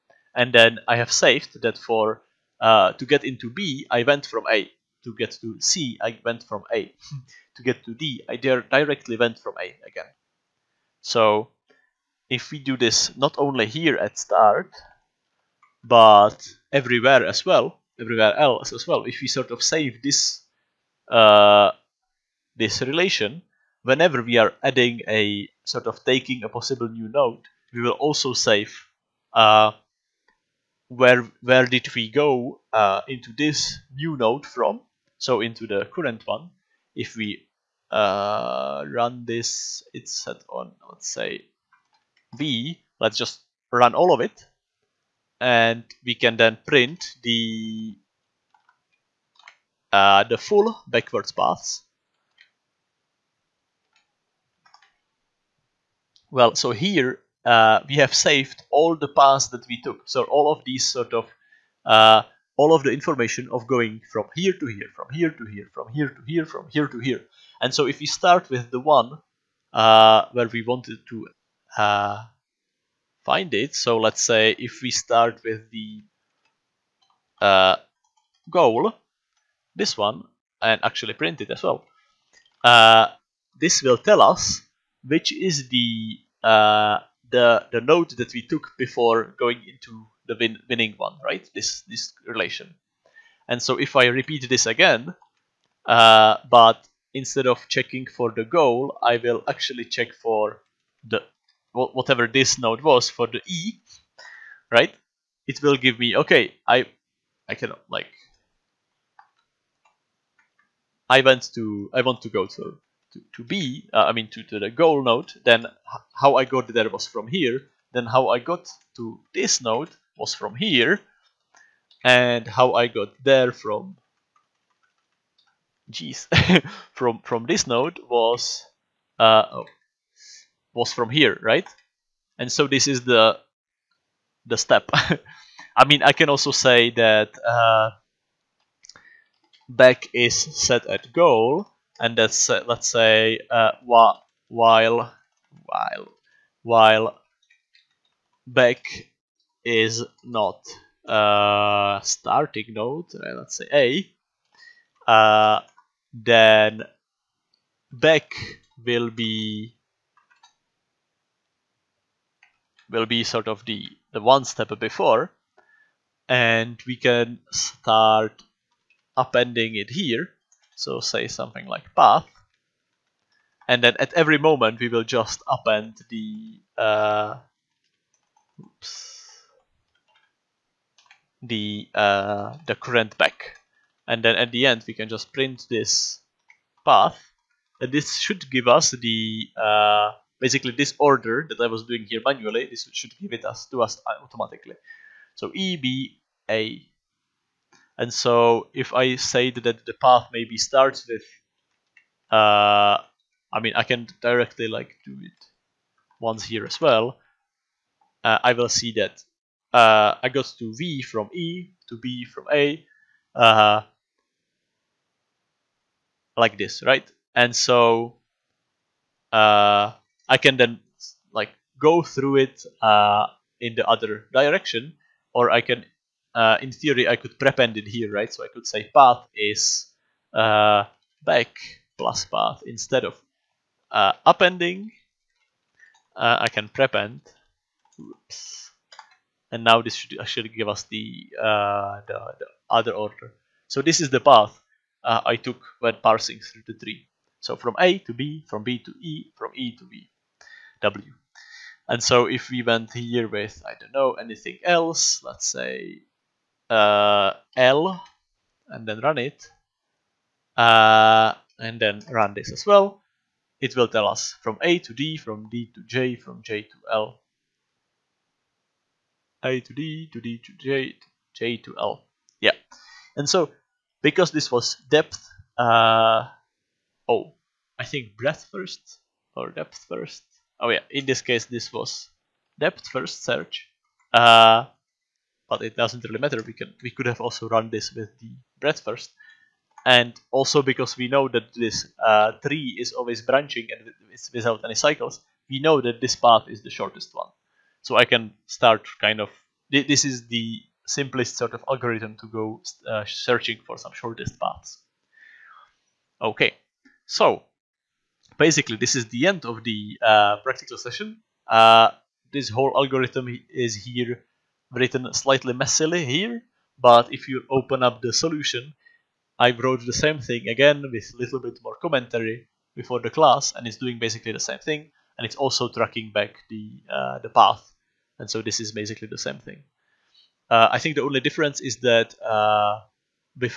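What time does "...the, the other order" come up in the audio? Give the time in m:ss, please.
4:02.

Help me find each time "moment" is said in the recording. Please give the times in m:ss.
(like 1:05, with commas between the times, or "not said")
2:54.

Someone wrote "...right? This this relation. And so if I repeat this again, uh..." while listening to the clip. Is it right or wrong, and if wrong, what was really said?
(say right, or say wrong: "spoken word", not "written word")
right.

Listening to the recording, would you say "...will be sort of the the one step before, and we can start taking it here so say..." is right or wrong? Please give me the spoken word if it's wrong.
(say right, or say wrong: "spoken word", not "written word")
wrong: "appending", not "taking".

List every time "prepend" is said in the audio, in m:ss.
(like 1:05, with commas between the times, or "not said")
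3:47, 3:56.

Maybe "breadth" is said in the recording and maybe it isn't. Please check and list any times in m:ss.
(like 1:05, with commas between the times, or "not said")
4:38, 4:48.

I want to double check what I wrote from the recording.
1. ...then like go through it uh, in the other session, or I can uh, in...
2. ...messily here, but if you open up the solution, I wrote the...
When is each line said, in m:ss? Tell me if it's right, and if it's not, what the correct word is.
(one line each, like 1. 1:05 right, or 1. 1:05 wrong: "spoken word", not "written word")
1. 3:40 wrong: "direction", not "session"
2. 5:15 right.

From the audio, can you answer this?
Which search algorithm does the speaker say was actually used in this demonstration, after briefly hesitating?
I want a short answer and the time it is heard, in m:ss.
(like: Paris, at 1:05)
depth first search, at 4:42.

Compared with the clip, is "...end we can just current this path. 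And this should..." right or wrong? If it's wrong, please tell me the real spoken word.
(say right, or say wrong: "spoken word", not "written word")
wrong: "print", not "current".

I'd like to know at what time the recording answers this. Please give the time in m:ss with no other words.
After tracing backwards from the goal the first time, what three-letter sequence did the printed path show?
3:15.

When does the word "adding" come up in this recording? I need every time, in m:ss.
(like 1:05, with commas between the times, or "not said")
0:24.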